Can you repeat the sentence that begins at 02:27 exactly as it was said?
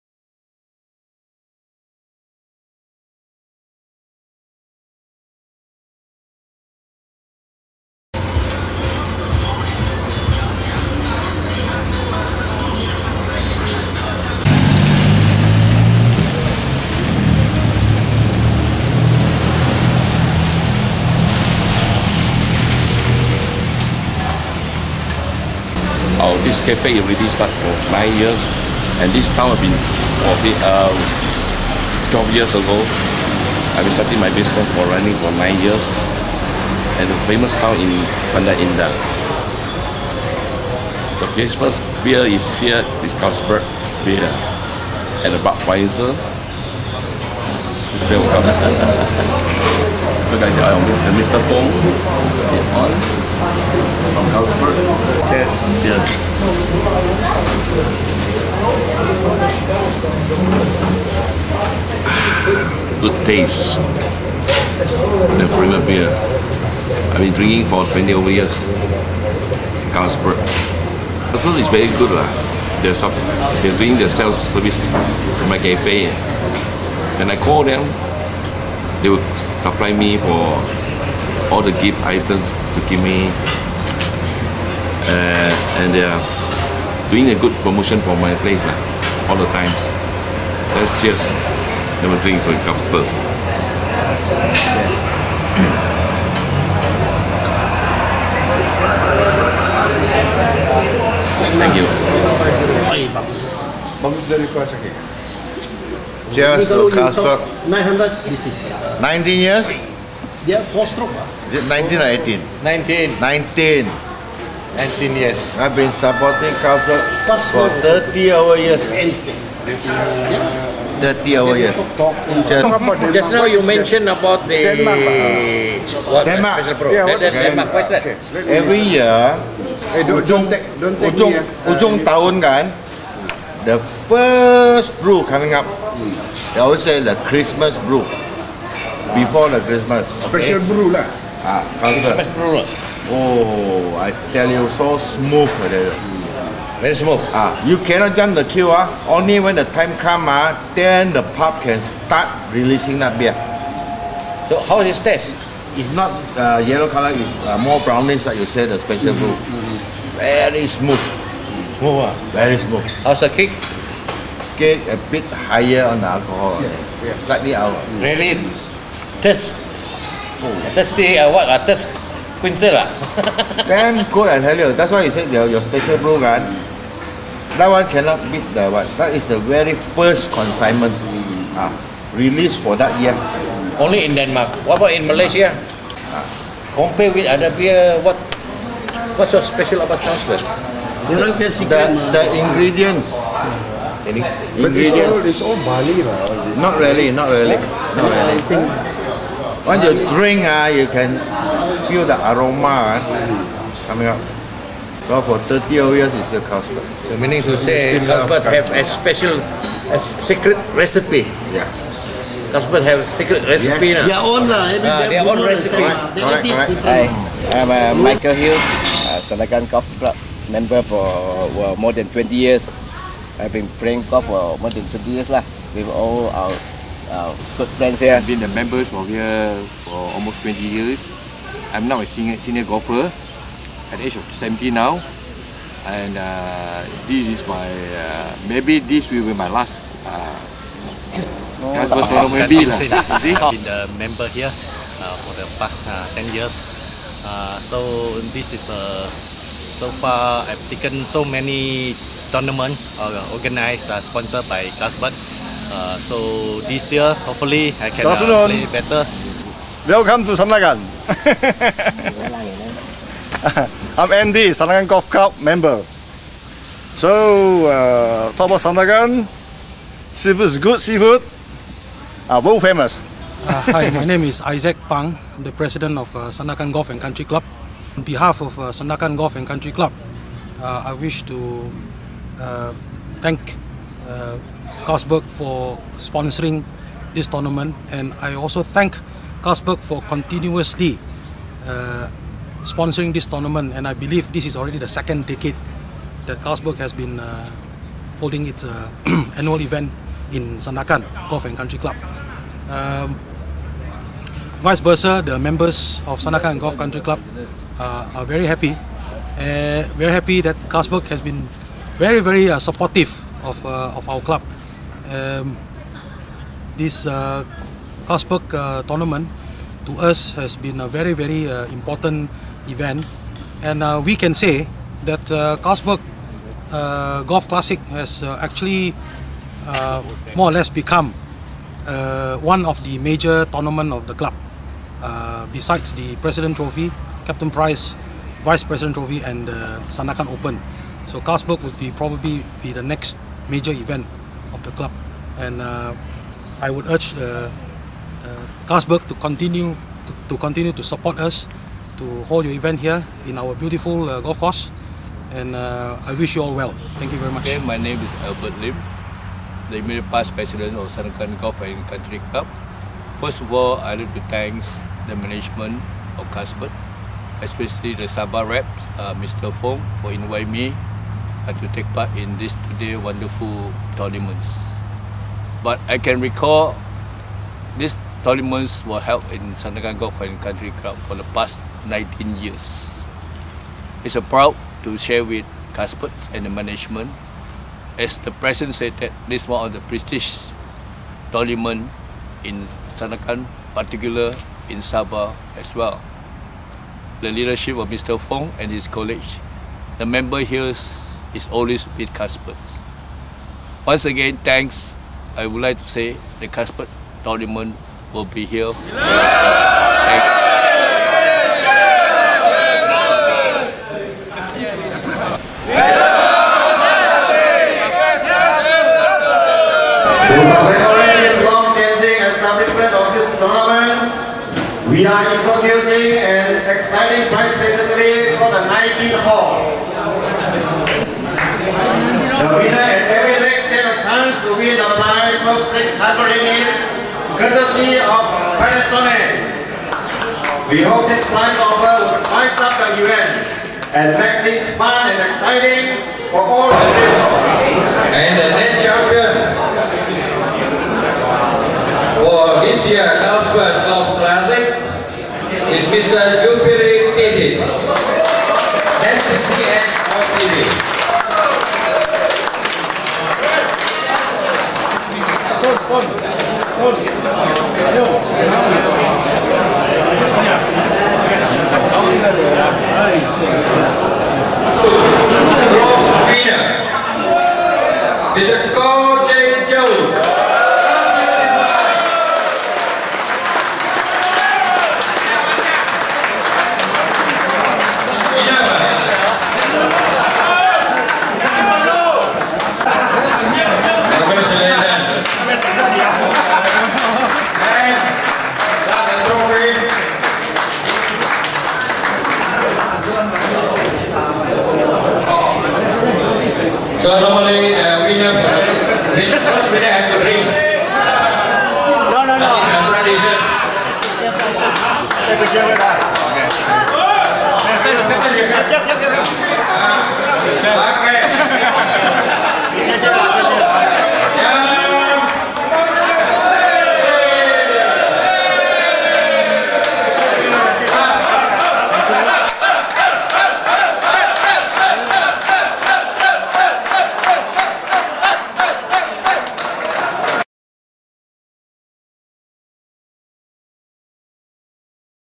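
Ah, you cannot jump the queue.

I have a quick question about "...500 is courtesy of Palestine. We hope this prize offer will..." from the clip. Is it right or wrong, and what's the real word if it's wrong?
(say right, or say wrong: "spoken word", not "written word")
wrong: "600", not "500".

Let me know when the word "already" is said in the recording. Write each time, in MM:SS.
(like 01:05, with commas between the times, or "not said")
00:26, 04:54.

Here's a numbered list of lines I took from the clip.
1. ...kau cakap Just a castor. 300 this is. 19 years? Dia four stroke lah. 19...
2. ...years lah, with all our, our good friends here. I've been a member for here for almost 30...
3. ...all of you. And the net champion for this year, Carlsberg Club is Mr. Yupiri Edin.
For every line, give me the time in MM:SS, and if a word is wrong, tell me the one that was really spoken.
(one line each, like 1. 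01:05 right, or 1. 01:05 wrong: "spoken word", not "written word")
1. 01:44 wrong: "900", not "300"
2. 03:45 wrong: "20", not "30"
3. 07:26 right.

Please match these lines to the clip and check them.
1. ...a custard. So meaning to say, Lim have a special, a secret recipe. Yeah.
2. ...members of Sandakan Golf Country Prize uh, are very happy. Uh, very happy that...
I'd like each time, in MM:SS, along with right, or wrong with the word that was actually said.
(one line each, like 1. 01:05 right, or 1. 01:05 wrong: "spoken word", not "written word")
1. 03:26 wrong: "Carlsberg", not "Lim"
2. 05:05 wrong: "Club", not "Prize".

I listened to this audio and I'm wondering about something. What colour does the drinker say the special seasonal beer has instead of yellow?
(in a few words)
brownish.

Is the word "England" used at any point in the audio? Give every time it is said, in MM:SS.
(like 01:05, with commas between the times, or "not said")
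not said.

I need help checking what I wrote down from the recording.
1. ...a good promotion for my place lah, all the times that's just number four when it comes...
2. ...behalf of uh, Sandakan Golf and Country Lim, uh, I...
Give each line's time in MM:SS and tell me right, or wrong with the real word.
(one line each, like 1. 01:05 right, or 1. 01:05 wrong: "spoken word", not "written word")
1. 01:27 wrong: "three", not "four"
2. 04:38 wrong: "Club", not "Lim".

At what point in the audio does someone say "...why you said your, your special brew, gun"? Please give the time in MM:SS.
02:54.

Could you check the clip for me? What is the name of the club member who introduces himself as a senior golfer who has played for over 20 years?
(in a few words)
Michael Hill.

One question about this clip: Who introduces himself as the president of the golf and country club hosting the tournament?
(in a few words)
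Isaac Pang.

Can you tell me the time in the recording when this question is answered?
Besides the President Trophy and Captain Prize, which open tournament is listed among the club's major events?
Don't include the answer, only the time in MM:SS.
05:39.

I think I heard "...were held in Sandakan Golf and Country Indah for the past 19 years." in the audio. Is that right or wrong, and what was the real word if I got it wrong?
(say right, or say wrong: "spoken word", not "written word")
wrong: "Club", not "Indah".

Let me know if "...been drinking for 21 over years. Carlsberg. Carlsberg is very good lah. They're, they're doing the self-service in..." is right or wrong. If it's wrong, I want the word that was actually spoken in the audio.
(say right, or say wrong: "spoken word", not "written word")
wrong: "20", not "21".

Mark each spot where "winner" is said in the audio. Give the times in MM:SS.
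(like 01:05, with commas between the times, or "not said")
07:12, 07:56.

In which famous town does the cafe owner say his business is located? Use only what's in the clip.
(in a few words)
Bandar Indah.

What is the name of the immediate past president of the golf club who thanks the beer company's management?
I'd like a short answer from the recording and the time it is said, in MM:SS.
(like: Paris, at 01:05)
Albert Lim, at 05:58.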